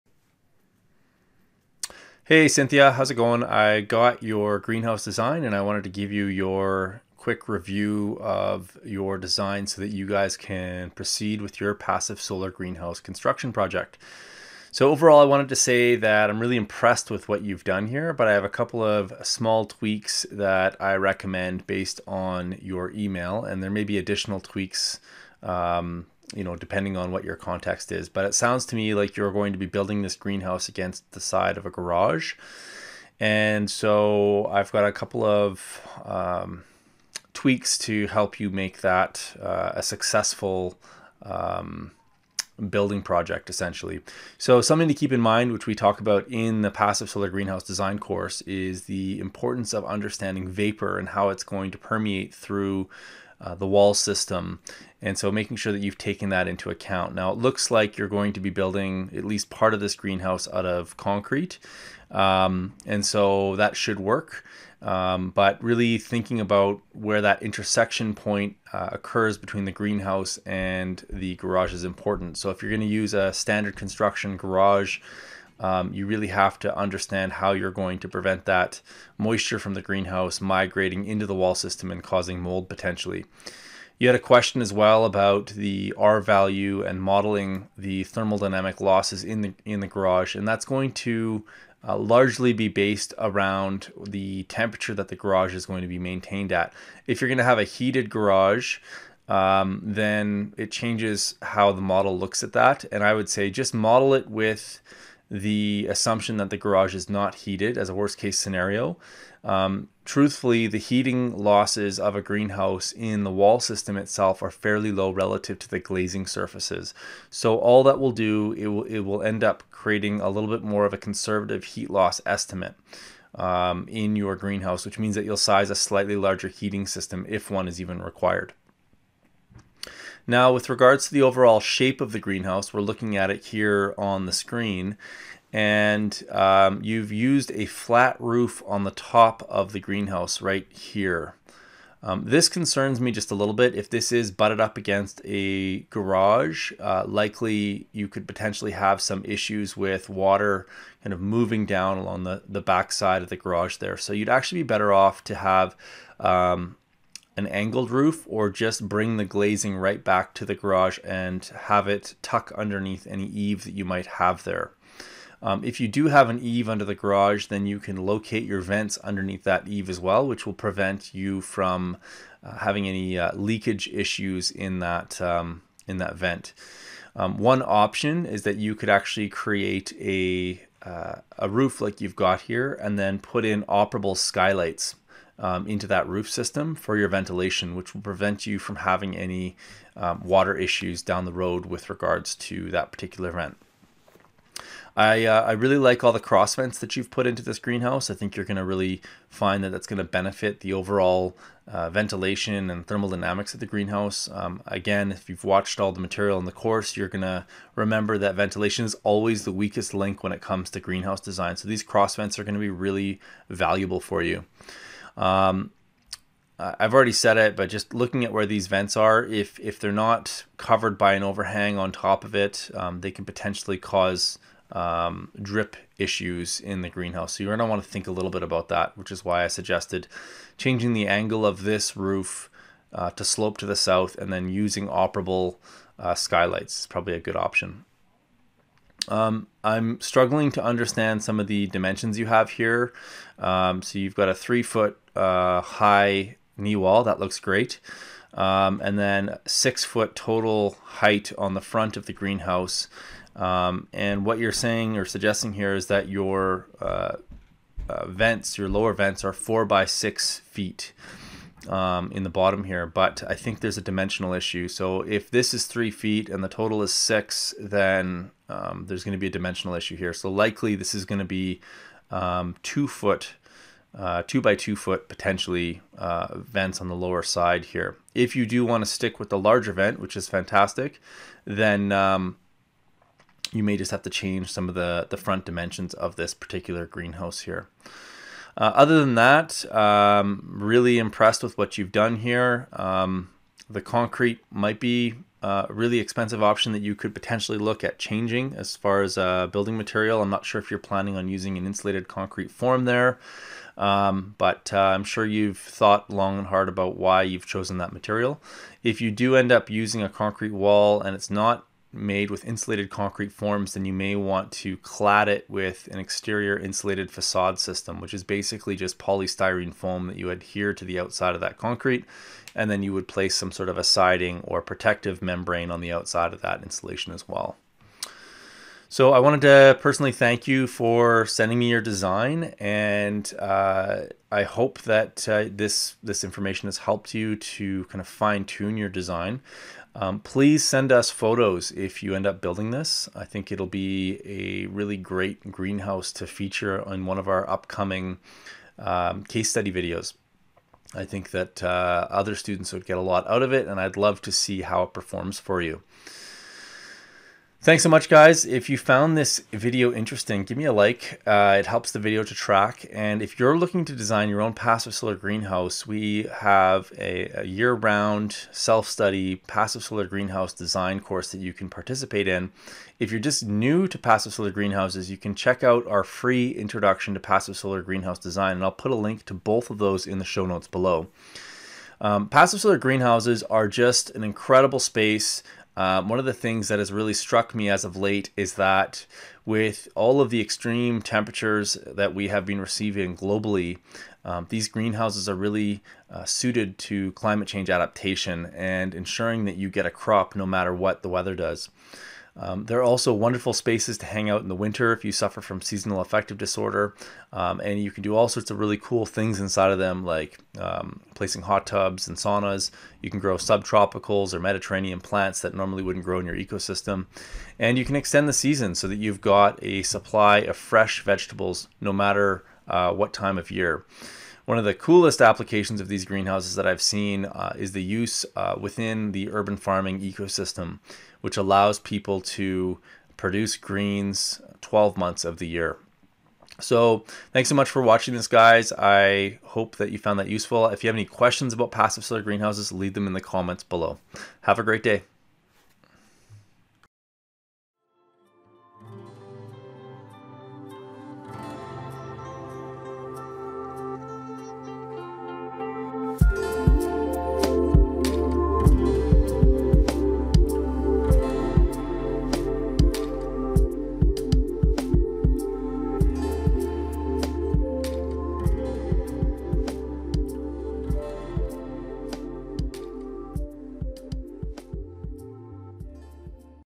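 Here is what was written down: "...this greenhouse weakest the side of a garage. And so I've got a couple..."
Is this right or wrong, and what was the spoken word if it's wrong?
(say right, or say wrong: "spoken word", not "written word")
wrong: "against", not "weakest".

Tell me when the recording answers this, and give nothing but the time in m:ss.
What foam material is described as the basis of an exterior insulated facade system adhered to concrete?
5:18.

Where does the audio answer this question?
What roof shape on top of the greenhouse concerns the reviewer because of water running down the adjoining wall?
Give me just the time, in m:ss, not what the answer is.
2:17.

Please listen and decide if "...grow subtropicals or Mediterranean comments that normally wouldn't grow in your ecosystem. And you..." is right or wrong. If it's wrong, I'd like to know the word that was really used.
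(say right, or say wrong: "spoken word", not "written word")
wrong: "plants", not "comments".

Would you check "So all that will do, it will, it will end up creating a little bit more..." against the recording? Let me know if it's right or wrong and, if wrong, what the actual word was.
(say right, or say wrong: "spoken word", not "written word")
right.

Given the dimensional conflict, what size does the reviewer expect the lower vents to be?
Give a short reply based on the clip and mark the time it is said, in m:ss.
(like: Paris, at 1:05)
2 by 2 feet, at 4:34.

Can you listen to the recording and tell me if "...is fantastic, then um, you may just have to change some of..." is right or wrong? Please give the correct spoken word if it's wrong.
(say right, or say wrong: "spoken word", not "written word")
right.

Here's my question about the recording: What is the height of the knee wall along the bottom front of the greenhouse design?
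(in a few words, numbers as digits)
3 feet.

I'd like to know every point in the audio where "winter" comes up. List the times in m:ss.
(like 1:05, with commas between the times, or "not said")
6:44.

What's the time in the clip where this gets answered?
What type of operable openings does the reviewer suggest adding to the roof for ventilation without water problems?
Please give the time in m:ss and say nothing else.
3:03.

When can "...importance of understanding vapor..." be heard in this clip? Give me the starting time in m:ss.
0:49.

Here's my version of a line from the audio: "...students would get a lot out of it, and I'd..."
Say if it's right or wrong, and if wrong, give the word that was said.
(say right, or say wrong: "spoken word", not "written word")
right.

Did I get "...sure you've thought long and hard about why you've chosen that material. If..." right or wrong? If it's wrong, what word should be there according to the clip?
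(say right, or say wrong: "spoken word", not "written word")
right.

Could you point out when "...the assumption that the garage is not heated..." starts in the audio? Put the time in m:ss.
1:45.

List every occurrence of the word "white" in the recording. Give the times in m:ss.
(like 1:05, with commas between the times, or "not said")
not said.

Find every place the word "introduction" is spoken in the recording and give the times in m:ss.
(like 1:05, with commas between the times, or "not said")
6:16.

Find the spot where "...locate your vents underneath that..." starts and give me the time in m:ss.
2:47.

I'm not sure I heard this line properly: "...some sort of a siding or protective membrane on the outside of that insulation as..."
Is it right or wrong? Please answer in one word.
right.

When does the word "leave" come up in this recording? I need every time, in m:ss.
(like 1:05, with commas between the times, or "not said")
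7:22.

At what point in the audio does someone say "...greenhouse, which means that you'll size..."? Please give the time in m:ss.
2:04.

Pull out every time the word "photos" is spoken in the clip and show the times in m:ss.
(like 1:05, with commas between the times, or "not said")
5:41.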